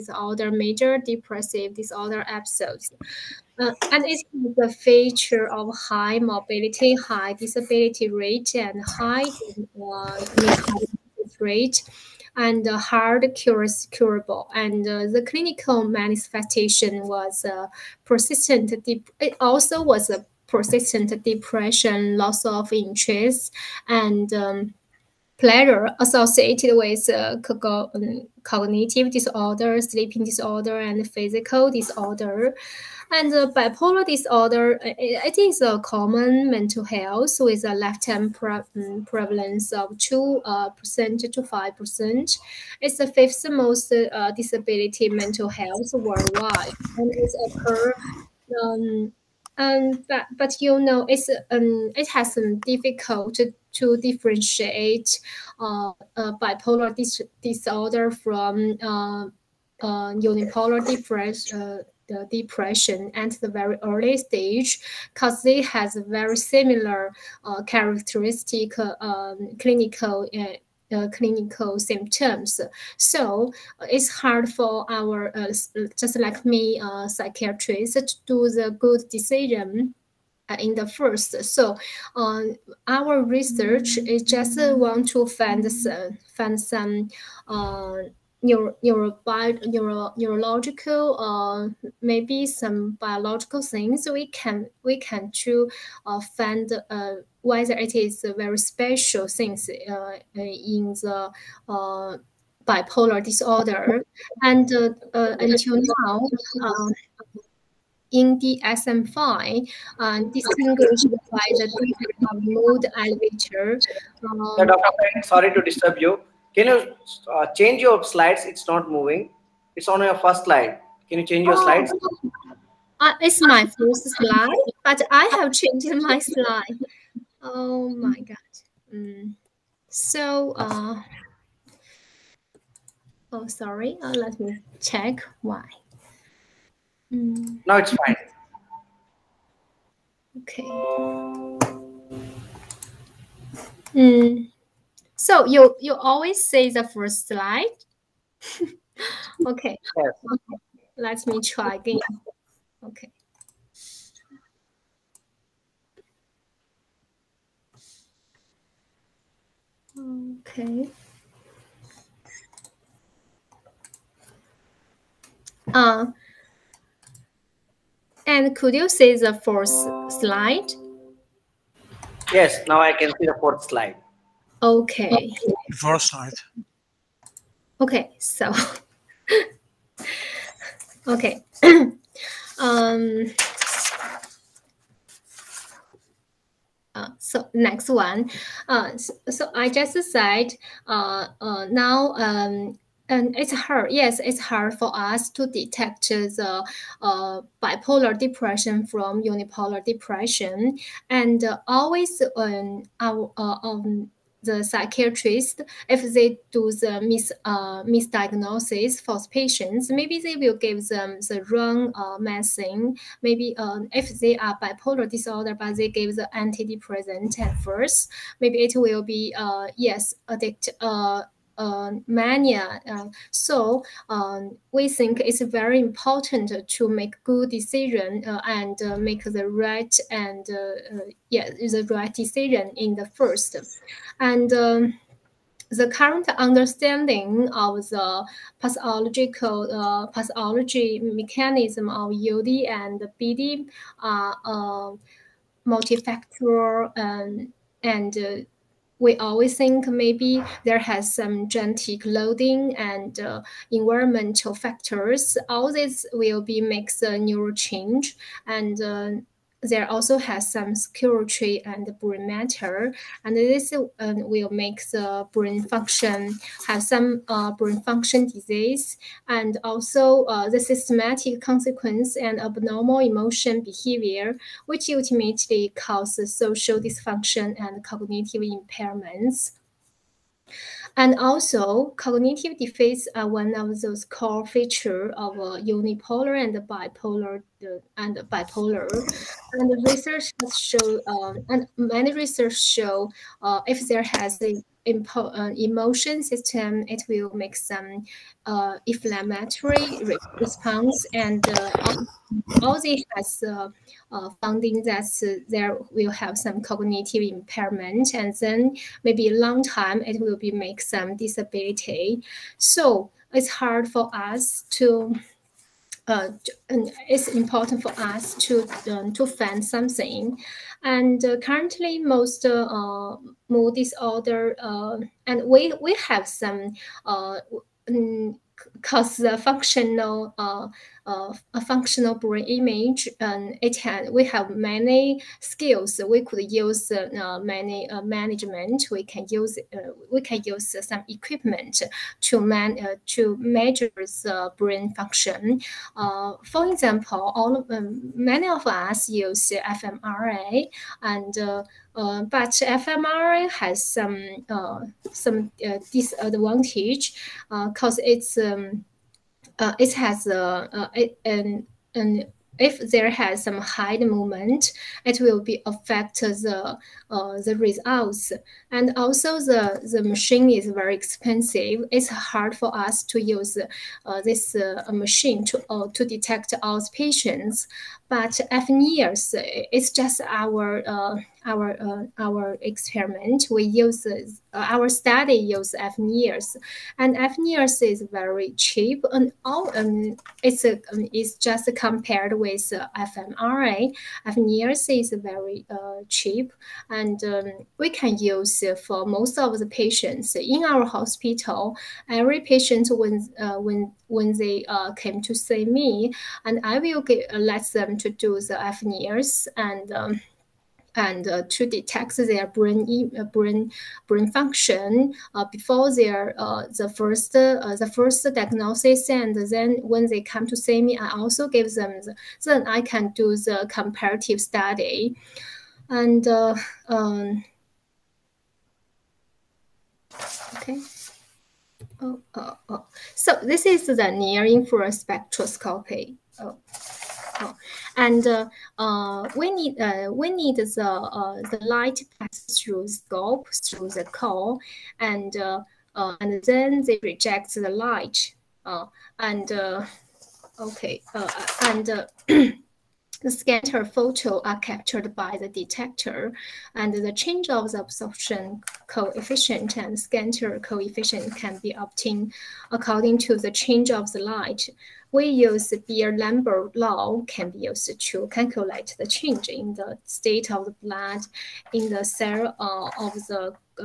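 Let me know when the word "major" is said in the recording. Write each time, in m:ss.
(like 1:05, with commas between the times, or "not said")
0:00.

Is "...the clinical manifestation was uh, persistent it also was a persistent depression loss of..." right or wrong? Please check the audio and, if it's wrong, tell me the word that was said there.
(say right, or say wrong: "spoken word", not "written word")
right.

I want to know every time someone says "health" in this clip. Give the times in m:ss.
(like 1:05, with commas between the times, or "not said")
0:36, 0:45.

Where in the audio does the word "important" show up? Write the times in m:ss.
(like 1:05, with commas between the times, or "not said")
3:45, 5:17.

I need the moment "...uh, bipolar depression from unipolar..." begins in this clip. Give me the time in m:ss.
3:17.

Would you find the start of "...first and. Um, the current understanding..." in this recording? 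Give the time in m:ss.
3:53.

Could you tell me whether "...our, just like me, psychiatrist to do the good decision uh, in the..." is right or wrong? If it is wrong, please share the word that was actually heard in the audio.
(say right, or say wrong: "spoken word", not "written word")
right.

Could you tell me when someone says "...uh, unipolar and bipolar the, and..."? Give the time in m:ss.
4:45.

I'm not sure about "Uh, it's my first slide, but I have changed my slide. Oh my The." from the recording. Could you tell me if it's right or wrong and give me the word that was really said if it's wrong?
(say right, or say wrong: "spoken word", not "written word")
wrong: "God", not "The".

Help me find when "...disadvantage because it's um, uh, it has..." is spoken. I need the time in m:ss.
5:55.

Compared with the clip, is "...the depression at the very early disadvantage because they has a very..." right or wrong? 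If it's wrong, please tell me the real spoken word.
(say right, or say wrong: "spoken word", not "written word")
wrong: "stage", not "disadvantage".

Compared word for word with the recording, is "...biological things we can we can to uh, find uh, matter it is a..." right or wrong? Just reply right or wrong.
wrong.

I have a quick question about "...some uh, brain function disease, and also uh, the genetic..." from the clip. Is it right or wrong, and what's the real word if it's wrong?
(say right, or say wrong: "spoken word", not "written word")
wrong: "systematic", not "genetic".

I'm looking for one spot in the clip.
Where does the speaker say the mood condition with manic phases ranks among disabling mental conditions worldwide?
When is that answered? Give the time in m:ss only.
0:43.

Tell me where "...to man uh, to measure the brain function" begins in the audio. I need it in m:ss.
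5:42.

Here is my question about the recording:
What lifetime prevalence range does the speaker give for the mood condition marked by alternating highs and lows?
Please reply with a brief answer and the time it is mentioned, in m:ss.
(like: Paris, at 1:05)
2% to 5%, at 0:39.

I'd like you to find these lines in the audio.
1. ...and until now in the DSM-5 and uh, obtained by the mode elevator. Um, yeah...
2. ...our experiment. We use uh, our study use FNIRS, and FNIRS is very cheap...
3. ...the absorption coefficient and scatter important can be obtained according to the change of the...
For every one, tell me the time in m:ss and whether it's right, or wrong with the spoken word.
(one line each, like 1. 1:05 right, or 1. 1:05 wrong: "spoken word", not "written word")
1. 1:44 wrong: "distinguished", not "obtained"
2. 6:22 right
3. 7:37 wrong: "coefficient", not "important".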